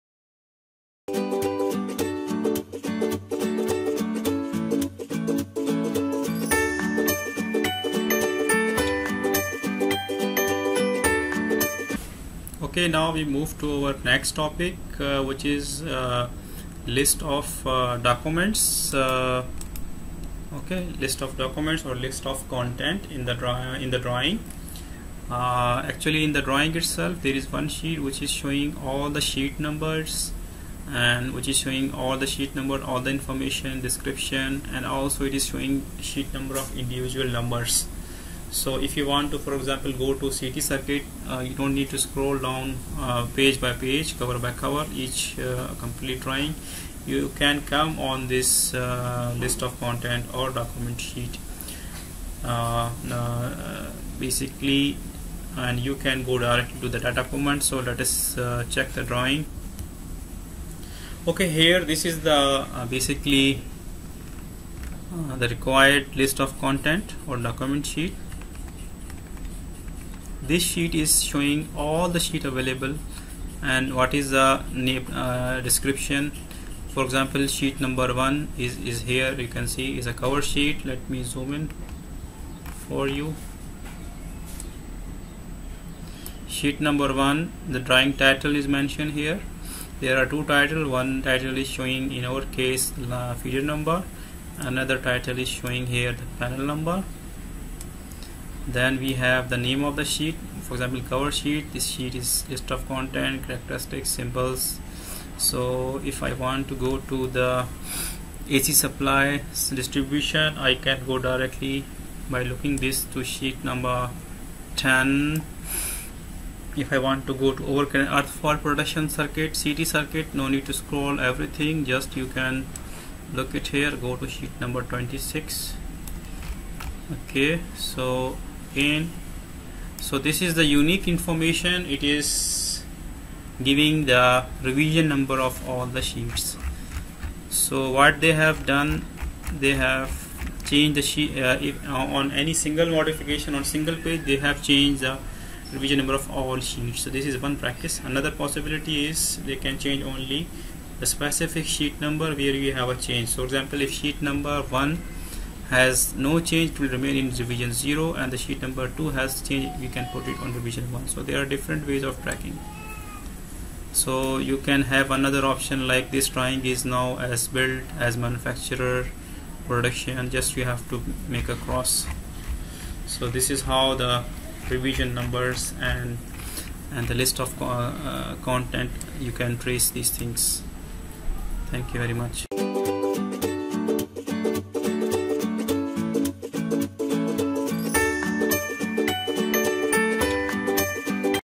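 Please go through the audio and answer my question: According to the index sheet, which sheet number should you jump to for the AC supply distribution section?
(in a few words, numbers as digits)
10.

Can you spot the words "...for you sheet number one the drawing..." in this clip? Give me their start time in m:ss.
1:22.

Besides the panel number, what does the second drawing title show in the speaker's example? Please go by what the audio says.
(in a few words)
feeder number.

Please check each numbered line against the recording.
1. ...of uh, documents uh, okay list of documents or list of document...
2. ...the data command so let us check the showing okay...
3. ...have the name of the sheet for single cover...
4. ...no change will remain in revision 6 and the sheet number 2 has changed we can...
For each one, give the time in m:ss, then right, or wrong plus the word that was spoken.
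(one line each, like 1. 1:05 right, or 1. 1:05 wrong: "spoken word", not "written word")
1. 0:17 wrong: "content", not "document"
2. 0:56 wrong: "drawing", not "showing"
3. 1:39 wrong: "example", not "single"
4. 2:36 wrong: "0", not "6".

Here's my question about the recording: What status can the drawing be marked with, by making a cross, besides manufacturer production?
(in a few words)
As built.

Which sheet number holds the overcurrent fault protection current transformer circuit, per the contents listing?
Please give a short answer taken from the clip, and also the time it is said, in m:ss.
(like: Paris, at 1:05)
26, at 2:04.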